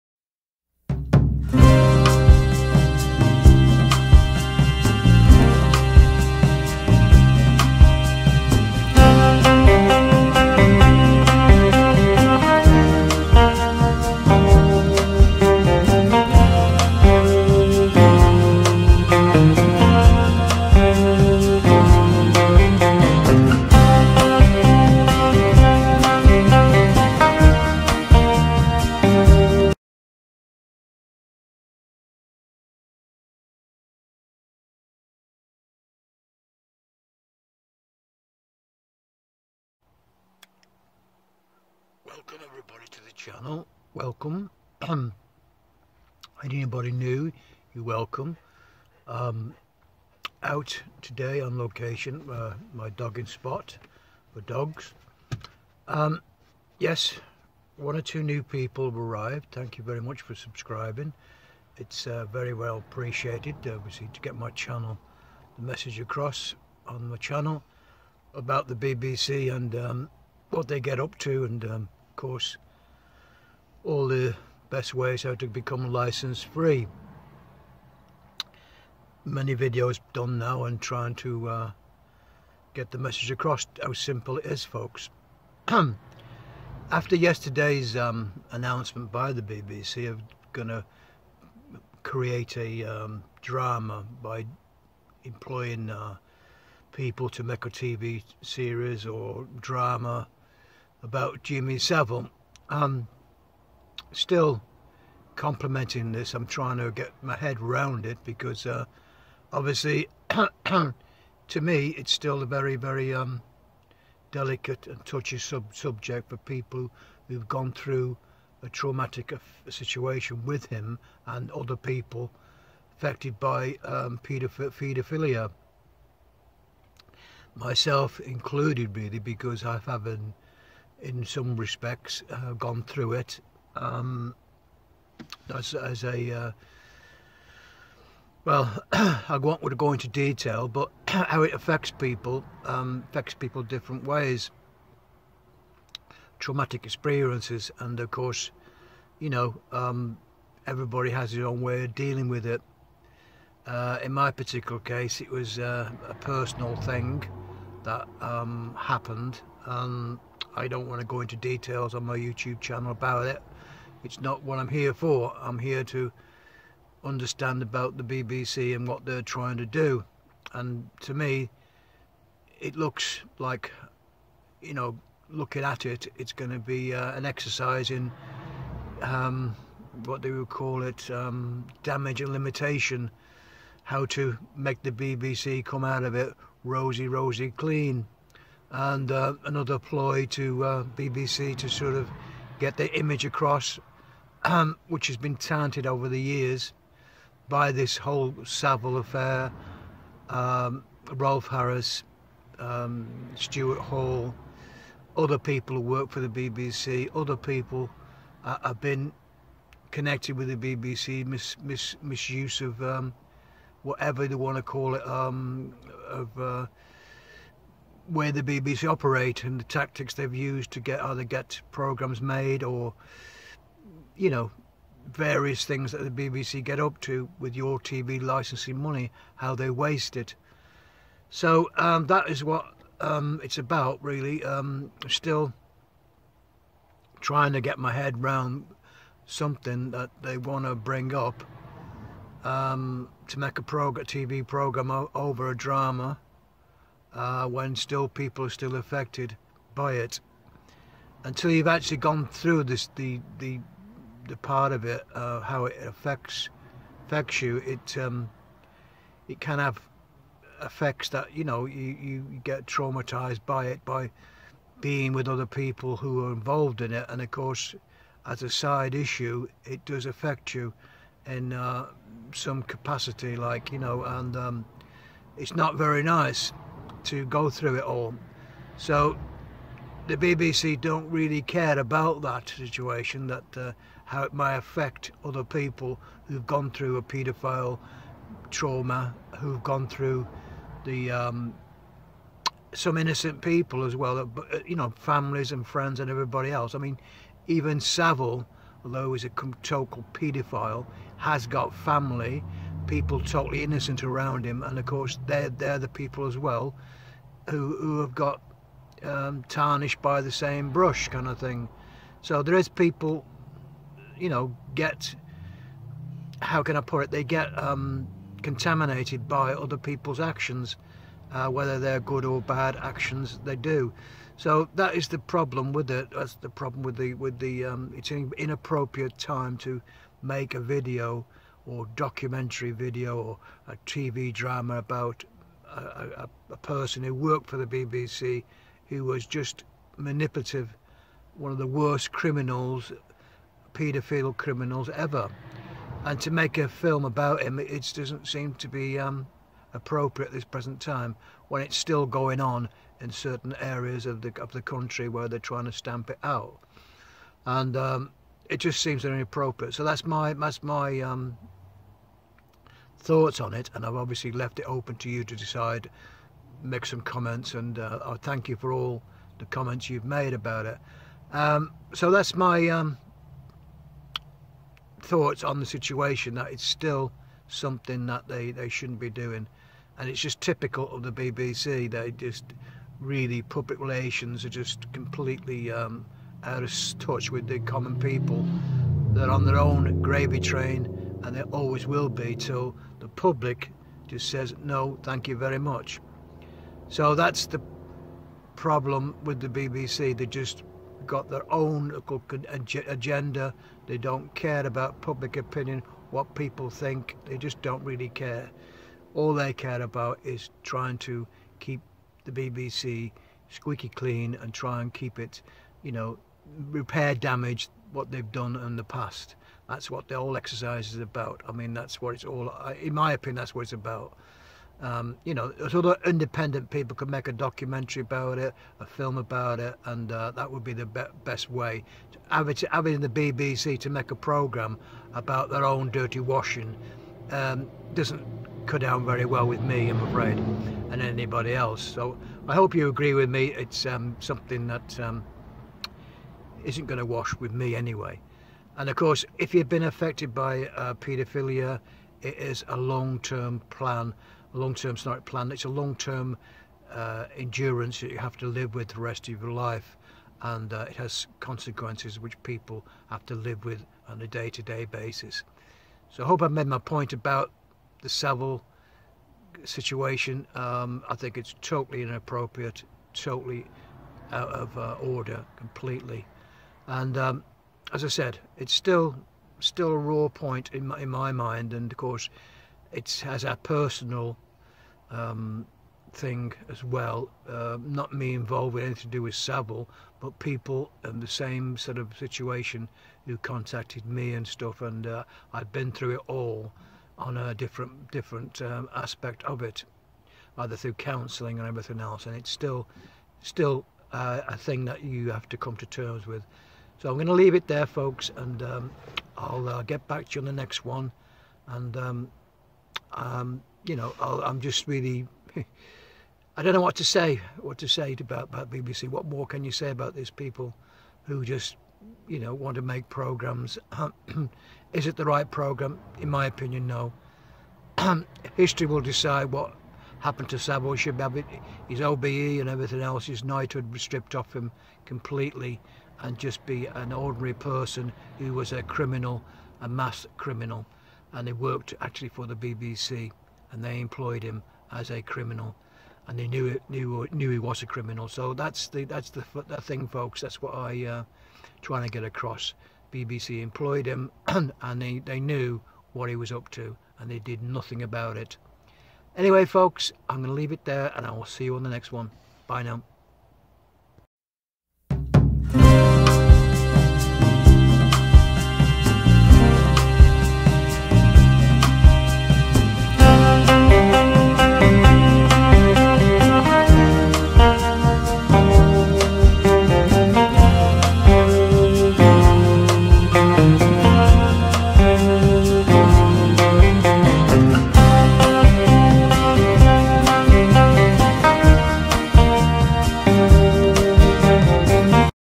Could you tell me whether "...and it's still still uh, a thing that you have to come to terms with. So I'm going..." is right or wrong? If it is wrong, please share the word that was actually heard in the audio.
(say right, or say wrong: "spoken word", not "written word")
right.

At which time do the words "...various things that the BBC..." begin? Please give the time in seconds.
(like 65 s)
225 s.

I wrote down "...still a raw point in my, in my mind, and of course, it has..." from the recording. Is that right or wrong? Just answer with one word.
right.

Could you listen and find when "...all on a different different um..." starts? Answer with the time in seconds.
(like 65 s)
496 s.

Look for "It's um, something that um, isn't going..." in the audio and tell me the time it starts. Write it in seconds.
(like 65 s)
443 s.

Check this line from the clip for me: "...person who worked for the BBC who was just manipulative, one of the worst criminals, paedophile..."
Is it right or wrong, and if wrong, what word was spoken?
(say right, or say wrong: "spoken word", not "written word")
right.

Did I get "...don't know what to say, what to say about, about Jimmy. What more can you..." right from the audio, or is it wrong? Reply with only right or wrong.
wrong.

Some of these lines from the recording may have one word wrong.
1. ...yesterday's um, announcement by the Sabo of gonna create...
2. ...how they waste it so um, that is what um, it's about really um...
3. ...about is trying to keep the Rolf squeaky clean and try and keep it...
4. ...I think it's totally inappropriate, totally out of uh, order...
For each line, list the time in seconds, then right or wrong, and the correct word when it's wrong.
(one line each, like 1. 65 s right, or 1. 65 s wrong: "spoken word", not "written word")
1. 87 s wrong: "BBC", not "Sabo"
2. 229 s right
3. 409 s wrong: "BBC", not "Rolf"
4. 471 s right.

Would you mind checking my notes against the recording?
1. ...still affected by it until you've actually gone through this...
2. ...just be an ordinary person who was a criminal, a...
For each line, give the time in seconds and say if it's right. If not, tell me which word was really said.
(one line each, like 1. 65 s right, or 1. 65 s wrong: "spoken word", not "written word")
1. 248 s right
2. 536 s right.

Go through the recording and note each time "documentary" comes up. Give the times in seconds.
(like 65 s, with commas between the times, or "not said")
331 s, 427 s.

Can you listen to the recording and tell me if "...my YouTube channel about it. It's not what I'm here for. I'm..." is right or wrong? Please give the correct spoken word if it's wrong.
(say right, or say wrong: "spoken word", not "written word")
right.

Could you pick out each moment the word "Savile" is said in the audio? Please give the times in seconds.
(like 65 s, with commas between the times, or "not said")
101 s, 198 s, 297 s, 468 s, 489 s.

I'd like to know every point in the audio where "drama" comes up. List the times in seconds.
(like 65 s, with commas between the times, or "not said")
93 s, 99 s, 245 s, 334 s.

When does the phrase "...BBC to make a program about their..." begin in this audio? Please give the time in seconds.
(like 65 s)
433 s.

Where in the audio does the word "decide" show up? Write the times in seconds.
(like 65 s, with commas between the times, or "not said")
365 s, 529 s.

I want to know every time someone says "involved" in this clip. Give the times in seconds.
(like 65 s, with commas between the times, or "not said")
266 s, 488 s.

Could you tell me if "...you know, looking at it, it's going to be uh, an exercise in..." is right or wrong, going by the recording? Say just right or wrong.
right.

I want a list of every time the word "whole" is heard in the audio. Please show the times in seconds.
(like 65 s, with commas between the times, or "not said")
197 s, 420 s.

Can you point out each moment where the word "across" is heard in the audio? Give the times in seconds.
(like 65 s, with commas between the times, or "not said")
65 s, 83 s, 193 s, 552 s.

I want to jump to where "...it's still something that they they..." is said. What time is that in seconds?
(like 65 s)
376 s.